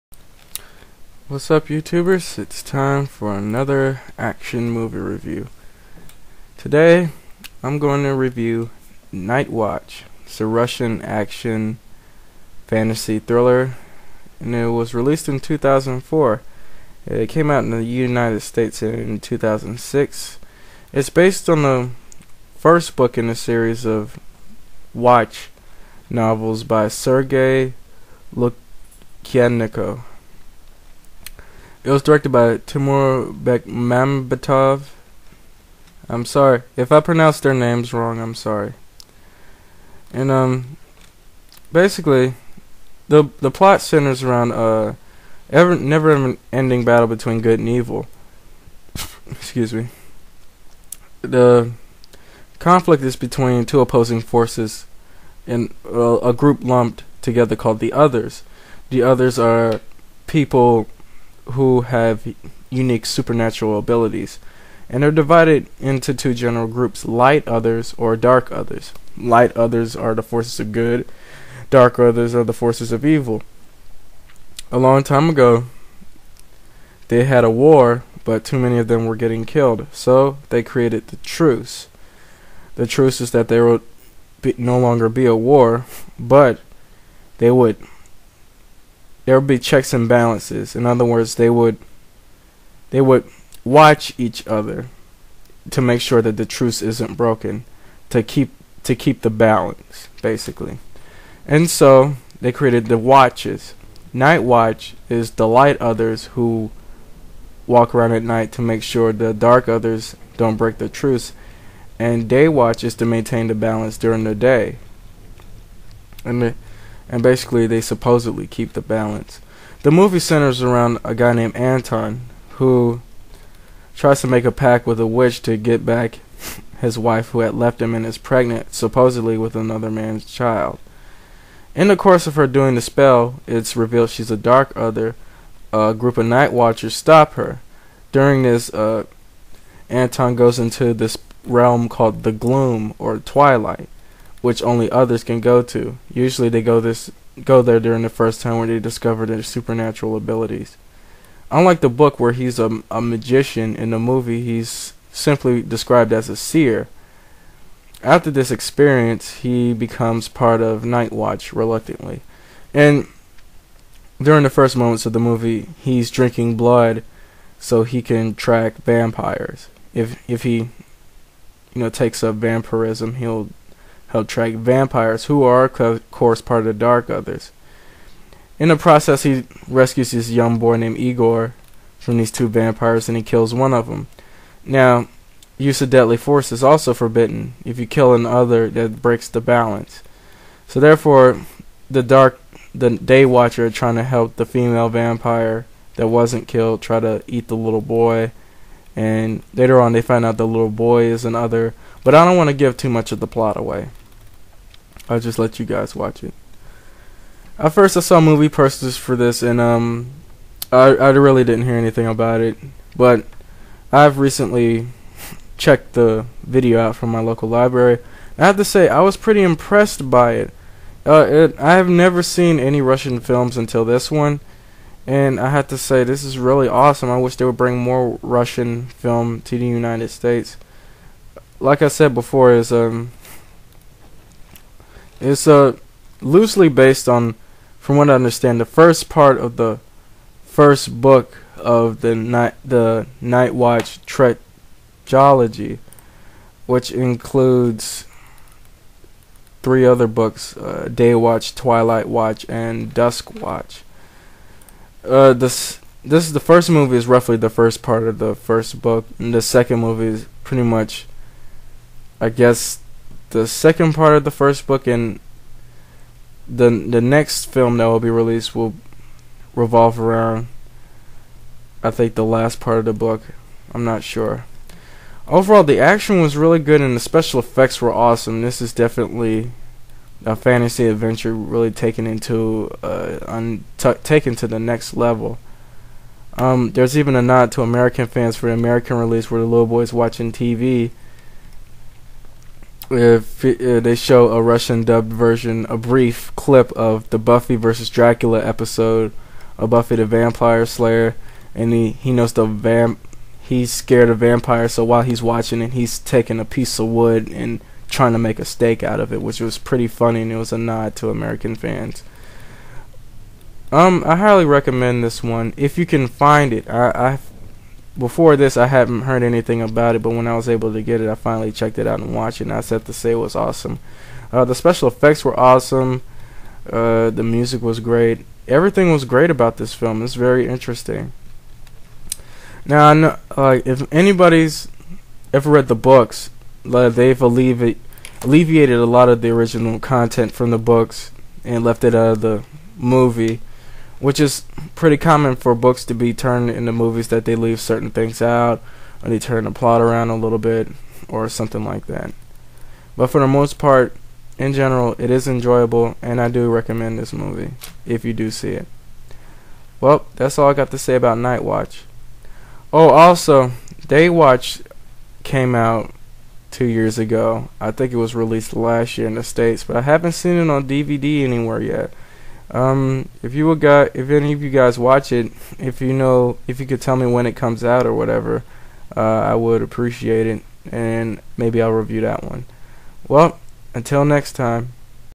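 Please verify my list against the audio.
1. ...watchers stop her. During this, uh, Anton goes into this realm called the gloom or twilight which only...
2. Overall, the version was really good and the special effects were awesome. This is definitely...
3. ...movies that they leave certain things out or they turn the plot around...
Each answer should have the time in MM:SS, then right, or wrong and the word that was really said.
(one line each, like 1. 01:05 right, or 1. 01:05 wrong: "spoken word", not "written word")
1. 02:16 right
2. 04:35 wrong: "action", not "version"
3. 05:46 right.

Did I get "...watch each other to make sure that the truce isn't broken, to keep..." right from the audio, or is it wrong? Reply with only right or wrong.
right.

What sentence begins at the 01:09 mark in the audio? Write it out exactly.
Light others are the forces of good, dark others are the forces of evil.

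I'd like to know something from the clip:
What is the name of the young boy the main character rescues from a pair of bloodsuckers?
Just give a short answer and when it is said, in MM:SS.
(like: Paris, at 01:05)
Igor, at 03:00.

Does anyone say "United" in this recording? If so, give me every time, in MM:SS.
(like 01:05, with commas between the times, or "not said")
00:17, 03:49.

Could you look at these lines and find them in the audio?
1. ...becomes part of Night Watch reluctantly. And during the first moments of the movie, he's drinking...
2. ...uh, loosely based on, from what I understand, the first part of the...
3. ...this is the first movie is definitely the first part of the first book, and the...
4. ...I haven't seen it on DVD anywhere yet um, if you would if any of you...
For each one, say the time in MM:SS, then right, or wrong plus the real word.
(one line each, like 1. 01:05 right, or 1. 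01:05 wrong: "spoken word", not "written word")
1. 02:39 right
2. 03:55 right
3. 04:16 wrong: "roughly", not "definitely"
4. 06:09 right.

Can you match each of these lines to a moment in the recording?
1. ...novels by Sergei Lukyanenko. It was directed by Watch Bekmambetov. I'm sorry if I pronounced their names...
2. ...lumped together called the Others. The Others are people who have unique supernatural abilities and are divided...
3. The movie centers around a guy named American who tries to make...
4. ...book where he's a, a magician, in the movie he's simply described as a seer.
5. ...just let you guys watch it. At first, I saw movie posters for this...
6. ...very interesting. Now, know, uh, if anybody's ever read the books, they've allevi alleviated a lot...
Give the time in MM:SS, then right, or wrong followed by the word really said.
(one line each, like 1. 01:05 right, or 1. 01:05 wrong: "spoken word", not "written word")
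1. 00:26 wrong: "Timur", not "Watch"
2. 00:56 right
3. 01:59 wrong: "Anton", not "American"
4. 02:31 right
5. 03:25 right
6. 05:30 right.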